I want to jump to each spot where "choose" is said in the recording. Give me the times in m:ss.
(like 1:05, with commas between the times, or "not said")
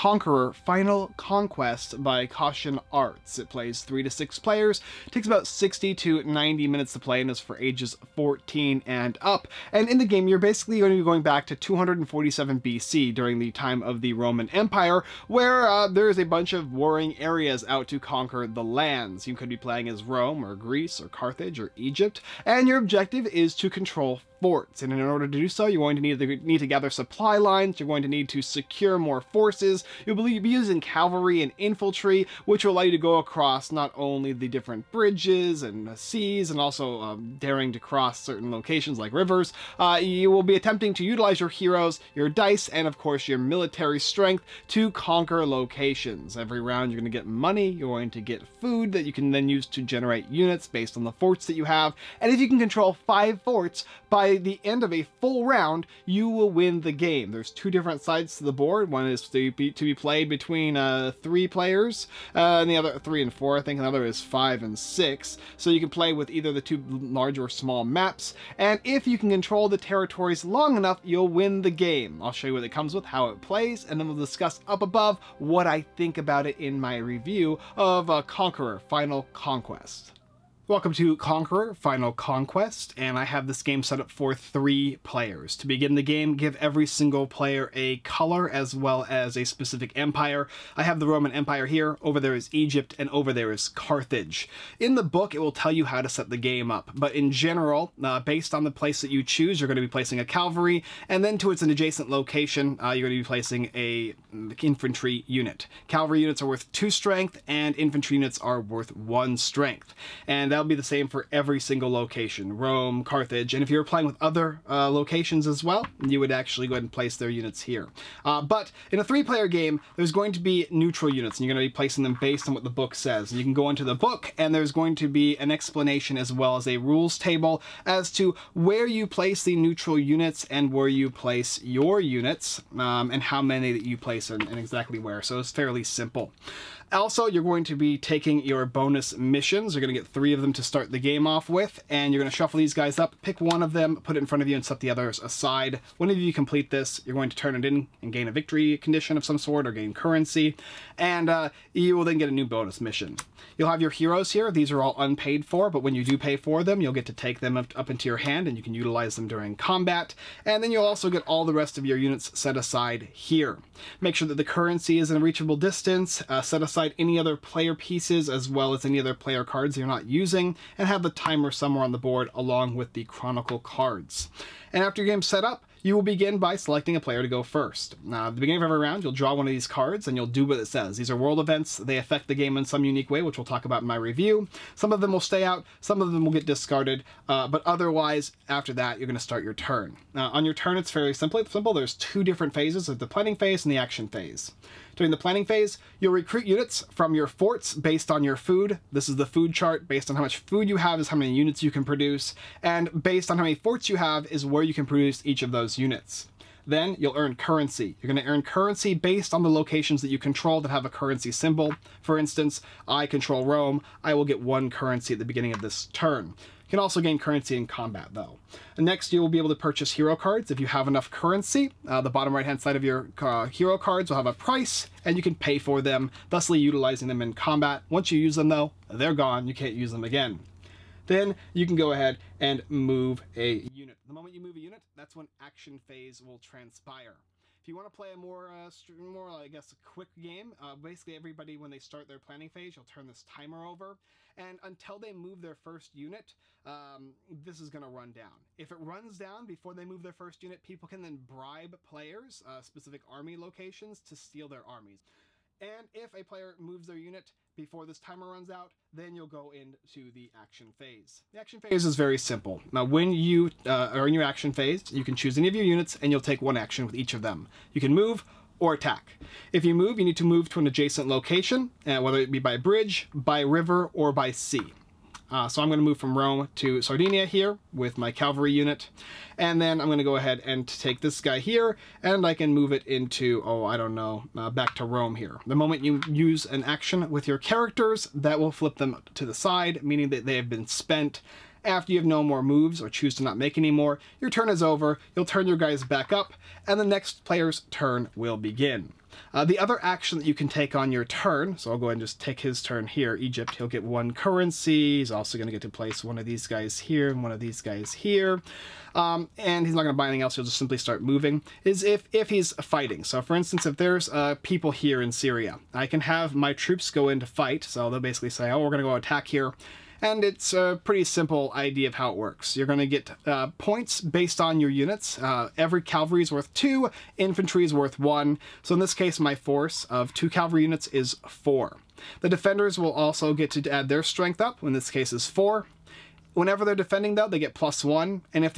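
1:39, 4:25, 4:52.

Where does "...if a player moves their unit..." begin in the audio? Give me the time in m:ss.
4:15.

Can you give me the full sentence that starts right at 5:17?
So they'll basically say, oh, we're going to go attack here.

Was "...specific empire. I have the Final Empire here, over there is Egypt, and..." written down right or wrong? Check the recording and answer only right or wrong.
wrong.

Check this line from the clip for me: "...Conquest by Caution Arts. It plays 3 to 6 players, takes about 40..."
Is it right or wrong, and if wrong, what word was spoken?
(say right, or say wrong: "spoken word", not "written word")
wrong: "60", not "40".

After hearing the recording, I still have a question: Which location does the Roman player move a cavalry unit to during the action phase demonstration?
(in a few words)
Sardinia.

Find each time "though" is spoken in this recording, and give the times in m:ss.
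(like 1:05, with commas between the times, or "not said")
3:38, 3:48, 5:37.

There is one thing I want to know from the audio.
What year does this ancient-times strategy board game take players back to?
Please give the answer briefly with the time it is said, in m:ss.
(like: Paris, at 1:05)
247 BC, at 0:11.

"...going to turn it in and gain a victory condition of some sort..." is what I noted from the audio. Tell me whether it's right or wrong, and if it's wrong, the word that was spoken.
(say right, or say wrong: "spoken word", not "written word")
right.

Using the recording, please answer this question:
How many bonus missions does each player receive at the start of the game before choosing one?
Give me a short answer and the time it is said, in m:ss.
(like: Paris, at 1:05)
3, at 2:20.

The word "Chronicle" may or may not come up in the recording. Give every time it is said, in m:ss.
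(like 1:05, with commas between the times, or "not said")
2:53.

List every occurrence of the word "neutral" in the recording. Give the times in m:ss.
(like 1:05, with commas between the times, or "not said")
2:00, 2:09.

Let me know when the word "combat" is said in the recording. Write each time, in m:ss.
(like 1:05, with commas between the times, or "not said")
2:39, 3:37, 3:47.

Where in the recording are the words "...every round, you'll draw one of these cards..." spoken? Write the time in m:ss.
2:58.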